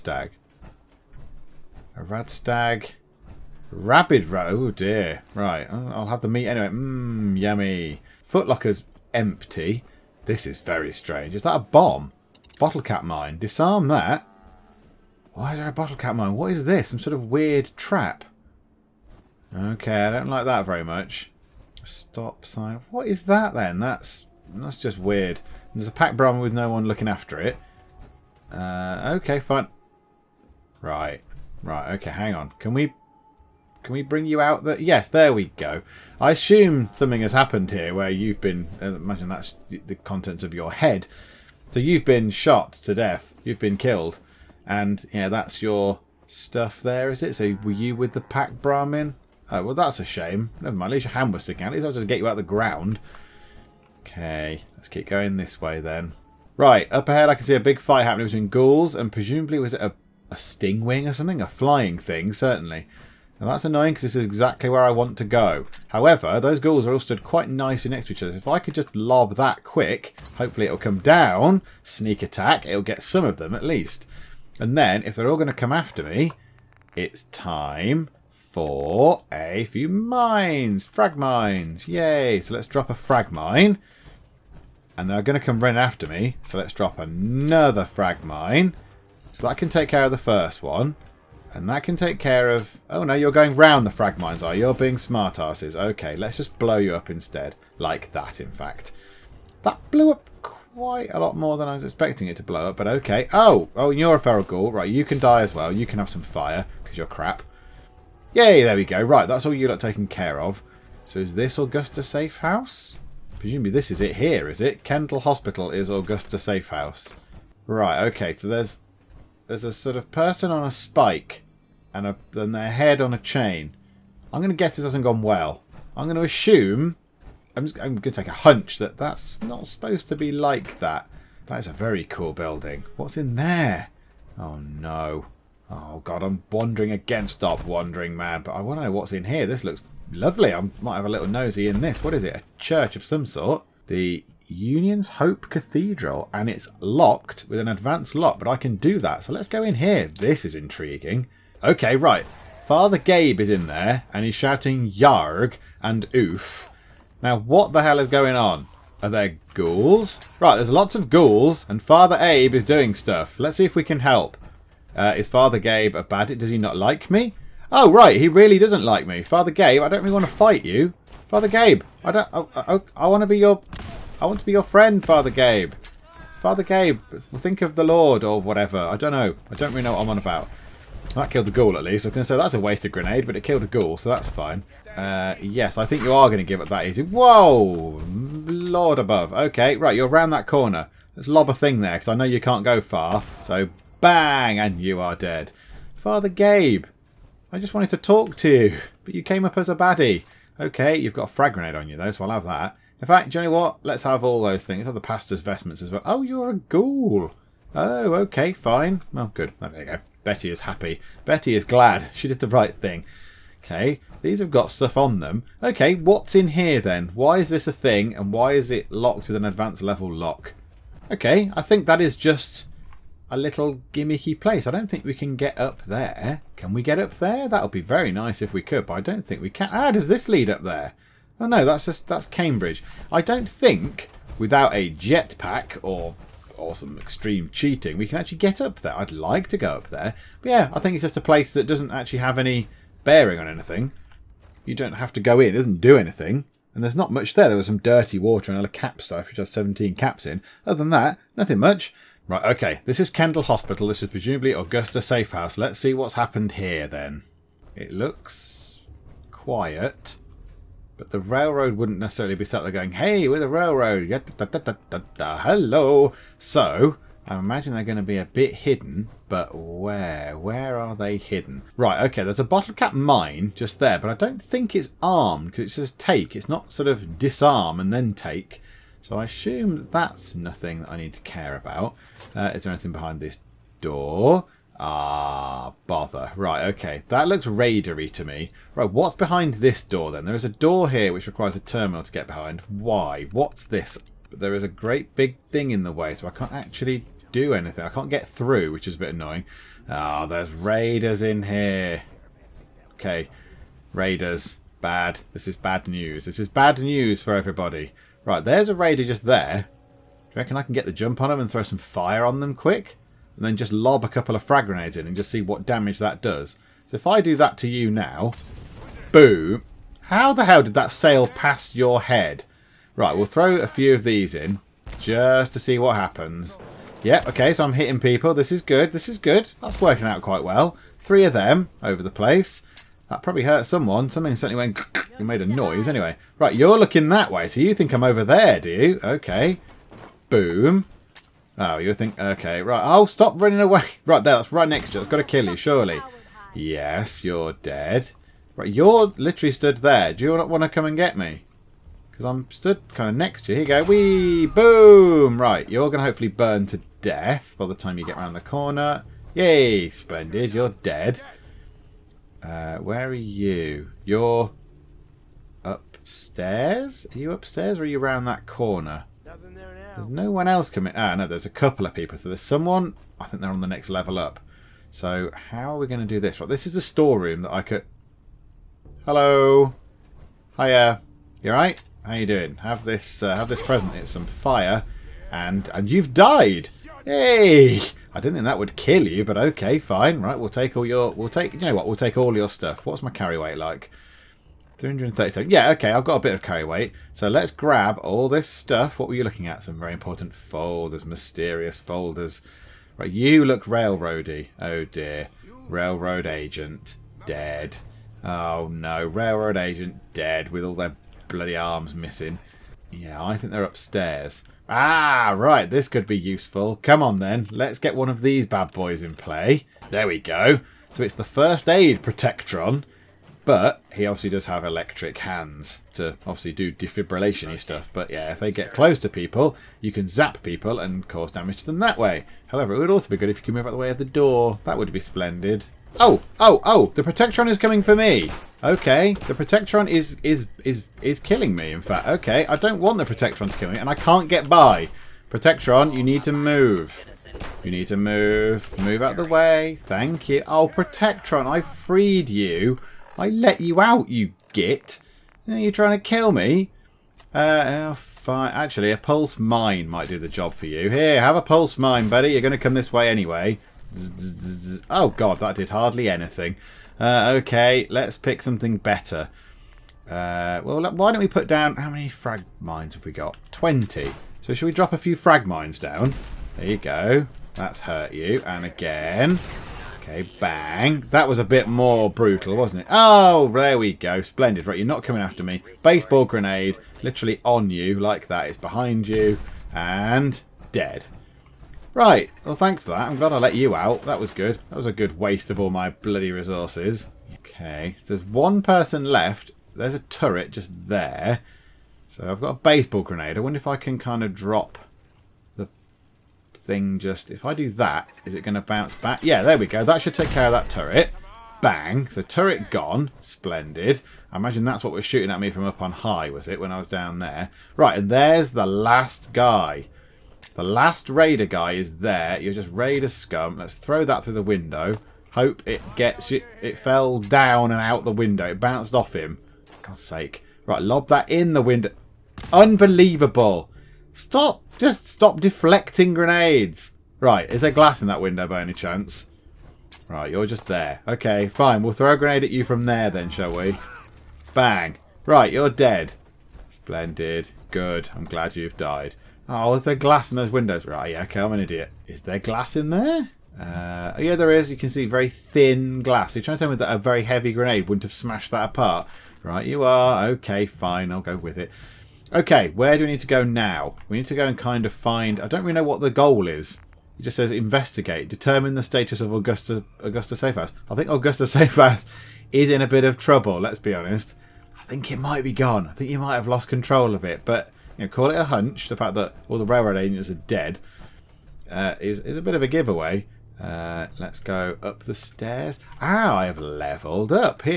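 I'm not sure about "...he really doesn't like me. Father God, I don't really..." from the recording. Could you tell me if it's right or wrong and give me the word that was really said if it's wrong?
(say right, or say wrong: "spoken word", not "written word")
wrong: "Gabe", not "God".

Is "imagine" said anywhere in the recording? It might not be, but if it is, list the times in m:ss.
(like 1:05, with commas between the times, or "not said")
0:38, 4:27, 8:34.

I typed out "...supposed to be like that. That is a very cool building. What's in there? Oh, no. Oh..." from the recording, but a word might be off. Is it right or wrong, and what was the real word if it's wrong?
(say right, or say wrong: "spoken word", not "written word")
right.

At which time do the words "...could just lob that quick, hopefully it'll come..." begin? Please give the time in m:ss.
1:08.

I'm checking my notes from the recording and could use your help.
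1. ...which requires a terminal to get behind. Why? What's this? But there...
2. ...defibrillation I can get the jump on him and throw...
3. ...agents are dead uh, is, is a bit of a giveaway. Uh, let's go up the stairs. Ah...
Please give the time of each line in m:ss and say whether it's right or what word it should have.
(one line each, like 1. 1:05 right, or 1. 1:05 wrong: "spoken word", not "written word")
1. 4:51 right
2. 5:10 wrong: "reckon", not "defibrillation"
3. 9:39 right.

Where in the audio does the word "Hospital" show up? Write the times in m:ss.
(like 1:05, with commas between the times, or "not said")
1:55, 4:13.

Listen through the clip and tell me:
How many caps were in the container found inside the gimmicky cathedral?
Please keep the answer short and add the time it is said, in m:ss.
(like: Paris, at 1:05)
17, at 4:09.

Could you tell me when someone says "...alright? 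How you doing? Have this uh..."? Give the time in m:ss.
6:21.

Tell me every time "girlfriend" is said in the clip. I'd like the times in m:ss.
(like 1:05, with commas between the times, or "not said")
not said.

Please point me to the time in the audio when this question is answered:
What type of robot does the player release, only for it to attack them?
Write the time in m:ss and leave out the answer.
7:01.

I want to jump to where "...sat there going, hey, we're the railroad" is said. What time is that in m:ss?
4:22.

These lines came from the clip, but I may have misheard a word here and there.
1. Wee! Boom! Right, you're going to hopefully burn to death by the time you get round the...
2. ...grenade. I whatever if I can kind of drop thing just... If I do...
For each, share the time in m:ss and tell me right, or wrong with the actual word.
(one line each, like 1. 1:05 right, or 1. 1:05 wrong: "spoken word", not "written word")
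1. 5:53 right
2. 8:23 wrong: "wonder", not "whatever".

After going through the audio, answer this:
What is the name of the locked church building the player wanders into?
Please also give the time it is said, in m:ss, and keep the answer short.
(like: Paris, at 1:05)
The Union's Hope Cathedral, at 2:23.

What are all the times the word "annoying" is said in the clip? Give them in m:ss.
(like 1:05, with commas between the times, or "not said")
1:03, 4:59.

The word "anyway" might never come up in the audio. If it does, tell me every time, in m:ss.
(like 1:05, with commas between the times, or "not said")
0:06, 5:35, 7:43.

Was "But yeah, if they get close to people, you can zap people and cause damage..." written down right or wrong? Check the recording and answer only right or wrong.
right.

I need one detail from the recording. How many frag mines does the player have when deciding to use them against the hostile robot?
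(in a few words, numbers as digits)
20.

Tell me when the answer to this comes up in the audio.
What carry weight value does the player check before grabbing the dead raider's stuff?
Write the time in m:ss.
6:34.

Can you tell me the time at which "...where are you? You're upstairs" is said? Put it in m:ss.
6:02.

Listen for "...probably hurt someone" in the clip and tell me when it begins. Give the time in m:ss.
5:33.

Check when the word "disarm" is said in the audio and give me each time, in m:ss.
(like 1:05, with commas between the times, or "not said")
0:13, 4:37.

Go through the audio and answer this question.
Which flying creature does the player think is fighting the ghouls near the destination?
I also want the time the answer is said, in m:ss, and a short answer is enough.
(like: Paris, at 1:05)
Stingwing, at 1:00.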